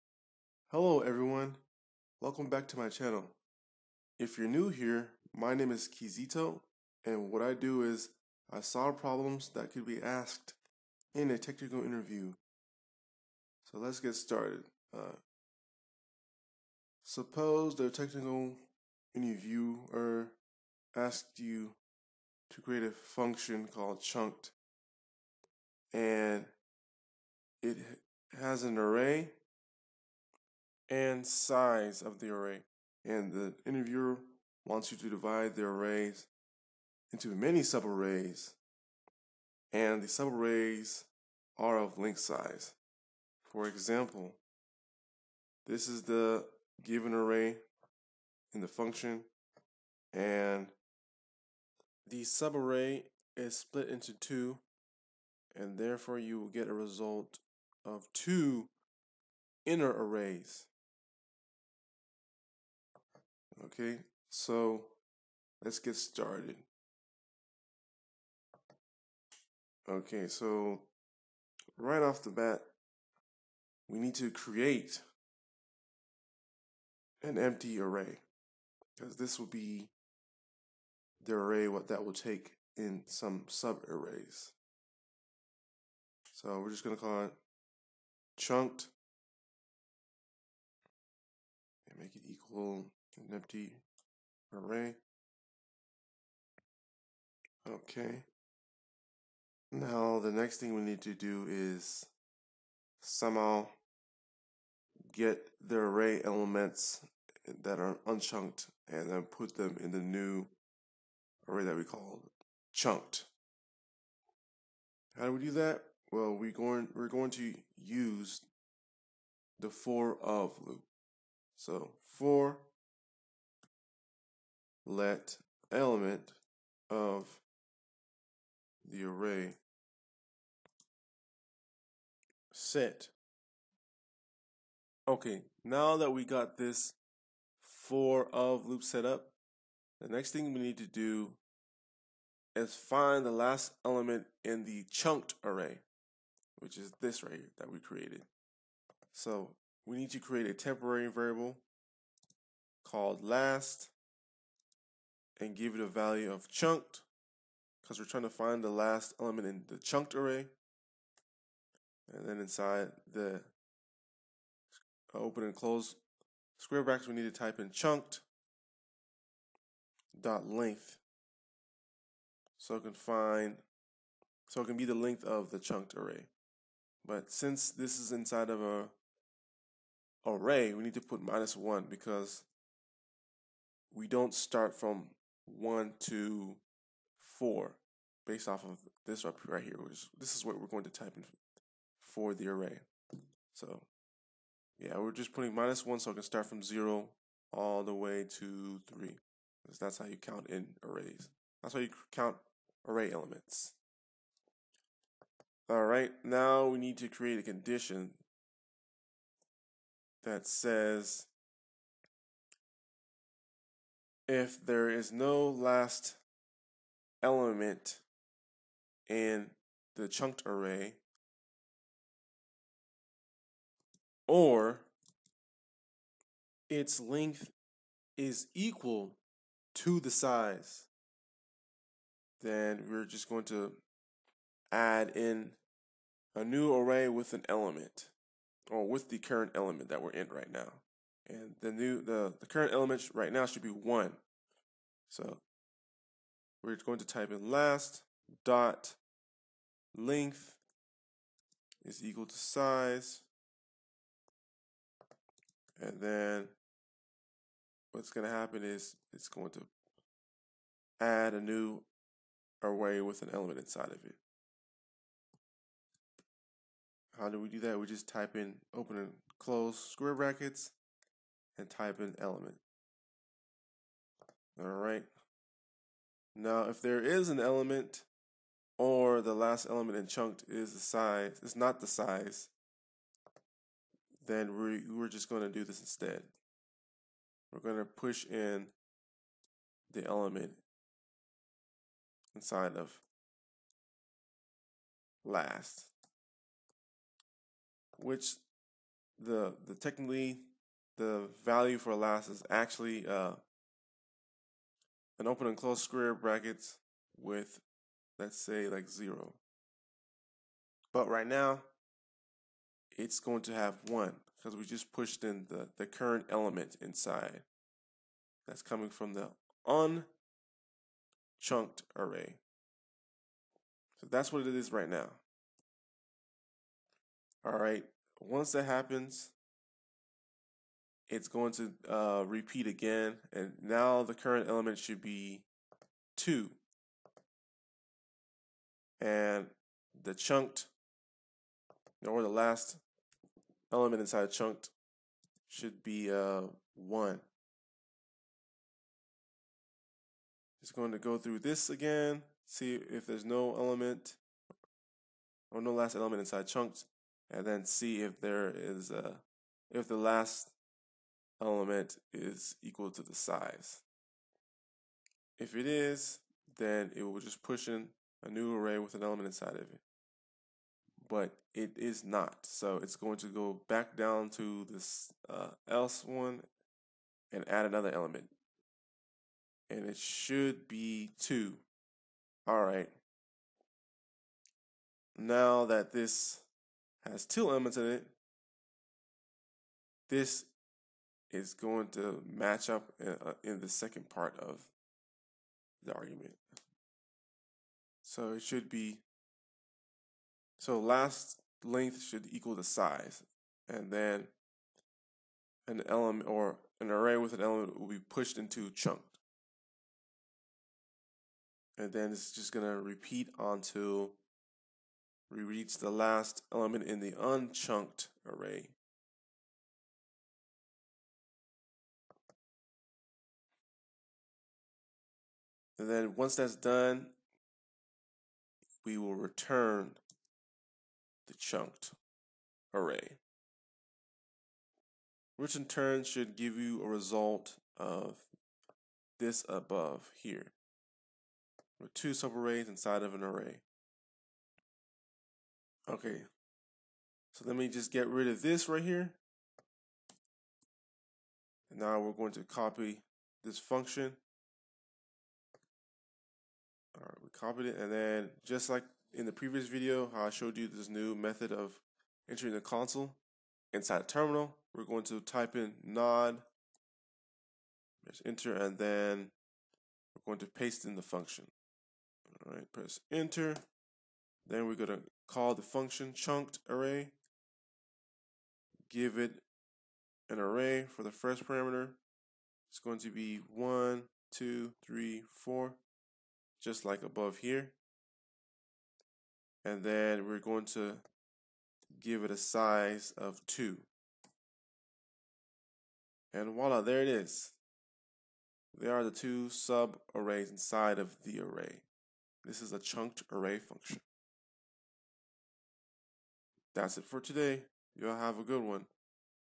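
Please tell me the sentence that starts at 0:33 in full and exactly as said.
And the interviewer wants you to divide the arrays into many subarrays, and the subarrays are of link size.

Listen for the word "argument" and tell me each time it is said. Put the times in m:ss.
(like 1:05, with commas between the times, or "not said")
6:35.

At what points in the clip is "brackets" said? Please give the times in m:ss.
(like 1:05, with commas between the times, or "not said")
2:46, 4:30, 5:06.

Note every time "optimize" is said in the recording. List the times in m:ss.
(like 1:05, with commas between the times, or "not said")
not said.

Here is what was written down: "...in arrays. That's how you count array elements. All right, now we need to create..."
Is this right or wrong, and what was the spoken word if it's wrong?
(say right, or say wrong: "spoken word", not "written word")
right.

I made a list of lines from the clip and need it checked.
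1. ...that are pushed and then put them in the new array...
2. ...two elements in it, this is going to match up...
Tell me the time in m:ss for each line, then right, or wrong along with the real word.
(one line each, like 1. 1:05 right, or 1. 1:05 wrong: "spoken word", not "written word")
1. 1:47 wrong: "unchunked", not "pushed"
2. 6:27 right.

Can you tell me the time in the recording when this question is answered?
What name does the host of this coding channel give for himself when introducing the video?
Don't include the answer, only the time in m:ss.
0:05.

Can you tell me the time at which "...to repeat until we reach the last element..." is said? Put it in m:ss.
6:52.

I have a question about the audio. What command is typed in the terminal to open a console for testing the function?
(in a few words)
node.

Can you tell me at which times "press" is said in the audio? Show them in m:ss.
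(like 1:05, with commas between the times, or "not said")
7:48, 7:52.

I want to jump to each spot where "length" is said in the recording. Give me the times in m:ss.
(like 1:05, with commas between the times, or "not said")
2:50, 2:54, 3:47, 4:09, 6:41.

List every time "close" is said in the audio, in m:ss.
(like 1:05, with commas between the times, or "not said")
2:45, 4:29, 5:05.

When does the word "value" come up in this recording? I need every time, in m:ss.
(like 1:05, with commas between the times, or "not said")
2:35, 5:01.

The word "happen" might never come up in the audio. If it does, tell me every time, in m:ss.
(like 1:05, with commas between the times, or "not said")
4:18, 5:28.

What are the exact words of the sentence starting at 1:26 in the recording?
So we're just going to call it chunked and make it equal an empty array.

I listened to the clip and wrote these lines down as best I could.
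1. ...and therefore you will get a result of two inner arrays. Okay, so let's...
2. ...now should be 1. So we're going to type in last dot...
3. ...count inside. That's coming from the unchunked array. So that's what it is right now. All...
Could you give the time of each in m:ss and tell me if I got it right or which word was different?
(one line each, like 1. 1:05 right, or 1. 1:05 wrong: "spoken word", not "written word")
1. 0:55 right
2. 4:03 right
3. 5:16 wrong: "element", not "count".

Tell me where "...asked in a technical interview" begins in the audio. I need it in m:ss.
0:10.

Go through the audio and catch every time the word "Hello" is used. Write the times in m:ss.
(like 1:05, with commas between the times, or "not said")
0:00.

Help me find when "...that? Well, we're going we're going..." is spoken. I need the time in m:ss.
1:55.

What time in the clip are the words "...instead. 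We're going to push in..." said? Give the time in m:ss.
4:45.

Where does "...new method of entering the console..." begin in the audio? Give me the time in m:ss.
7:40.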